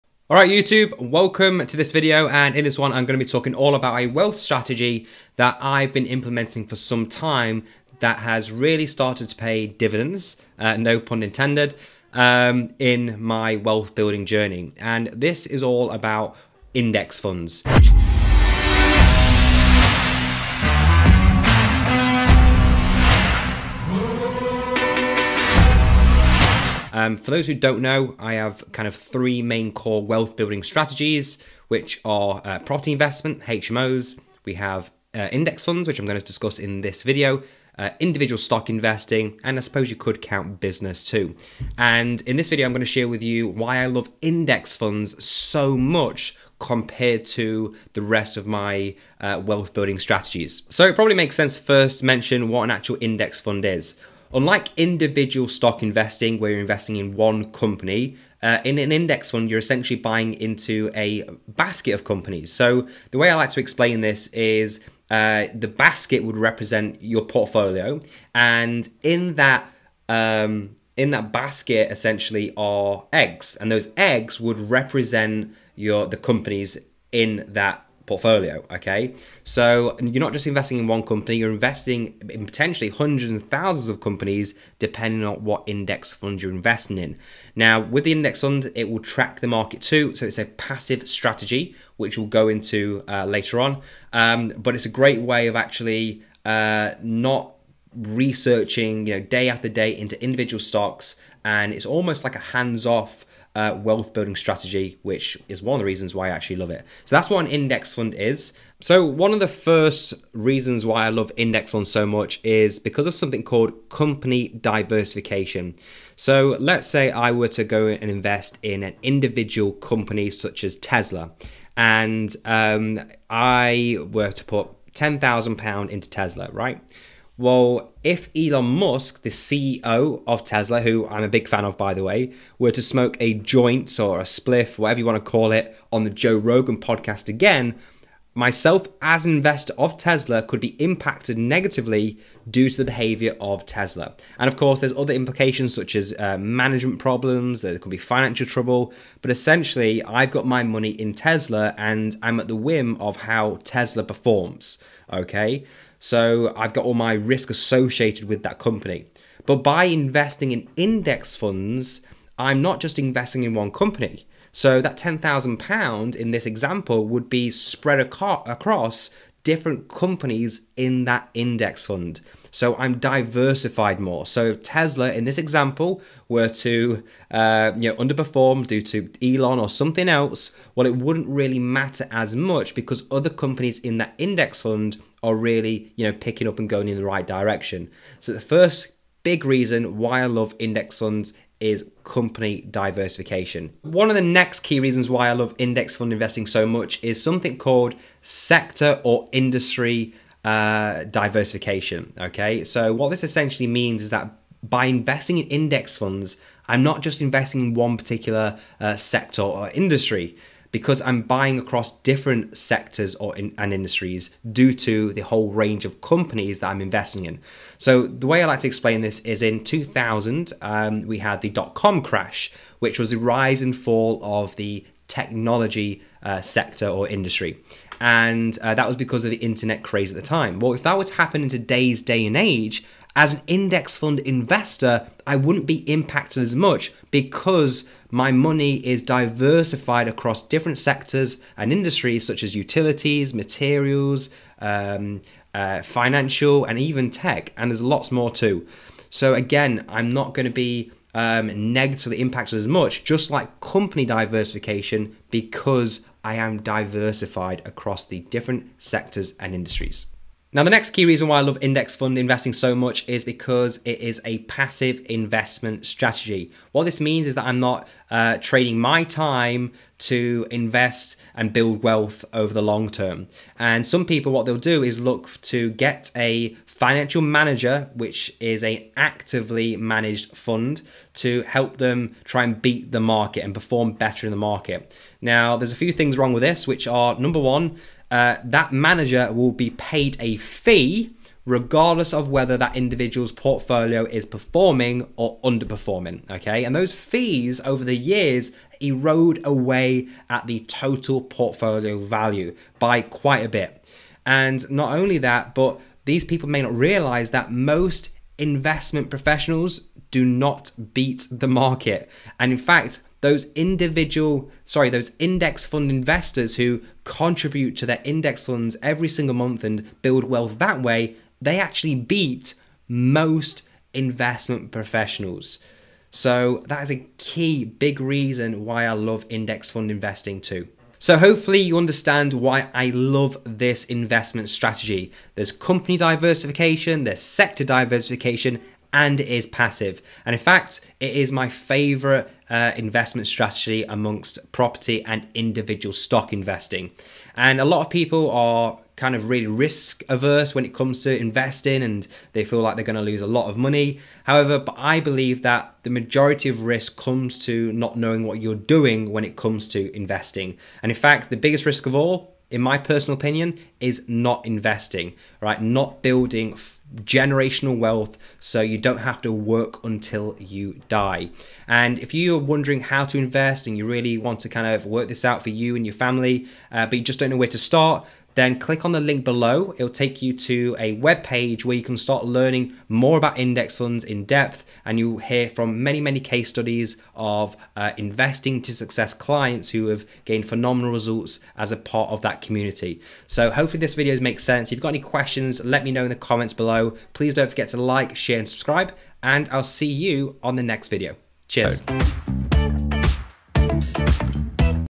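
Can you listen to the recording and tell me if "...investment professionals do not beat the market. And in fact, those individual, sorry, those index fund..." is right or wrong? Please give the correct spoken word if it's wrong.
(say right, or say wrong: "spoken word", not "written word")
right.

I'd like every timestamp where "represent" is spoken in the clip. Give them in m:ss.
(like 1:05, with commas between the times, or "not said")
1:06, 1:14.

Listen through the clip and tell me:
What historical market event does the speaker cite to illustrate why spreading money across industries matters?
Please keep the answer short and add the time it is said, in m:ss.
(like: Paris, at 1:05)
The dot com crash, at 3:41.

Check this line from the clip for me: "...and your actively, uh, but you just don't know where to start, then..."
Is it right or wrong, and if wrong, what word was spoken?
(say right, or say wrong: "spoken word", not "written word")
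wrong: "family", not "actively".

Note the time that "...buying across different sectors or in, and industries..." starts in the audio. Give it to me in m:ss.
3:31.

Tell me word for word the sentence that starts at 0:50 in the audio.
So it probably makes sense to first mention what an actual index fund is.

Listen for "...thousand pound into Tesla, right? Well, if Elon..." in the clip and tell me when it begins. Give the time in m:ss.
2:05.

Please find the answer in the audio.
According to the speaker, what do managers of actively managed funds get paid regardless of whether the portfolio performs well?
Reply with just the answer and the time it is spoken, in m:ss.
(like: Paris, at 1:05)
A fee, at 4:50.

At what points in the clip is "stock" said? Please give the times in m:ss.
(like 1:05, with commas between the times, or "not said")
0:38, 0:55, 1:40, 5:45.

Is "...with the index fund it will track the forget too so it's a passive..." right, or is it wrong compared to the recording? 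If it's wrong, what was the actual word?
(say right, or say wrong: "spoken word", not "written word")
wrong: "market", not "forget".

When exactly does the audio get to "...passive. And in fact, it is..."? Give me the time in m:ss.
5:39.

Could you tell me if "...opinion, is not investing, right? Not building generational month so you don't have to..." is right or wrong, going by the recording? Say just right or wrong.
wrong.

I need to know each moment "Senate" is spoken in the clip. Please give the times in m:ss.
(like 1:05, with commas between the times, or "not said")
not said.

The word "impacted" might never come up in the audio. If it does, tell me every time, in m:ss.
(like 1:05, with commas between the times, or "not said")
2:20, 3:55, 4:12.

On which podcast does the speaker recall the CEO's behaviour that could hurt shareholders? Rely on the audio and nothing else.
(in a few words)
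Joe Rogan podcast.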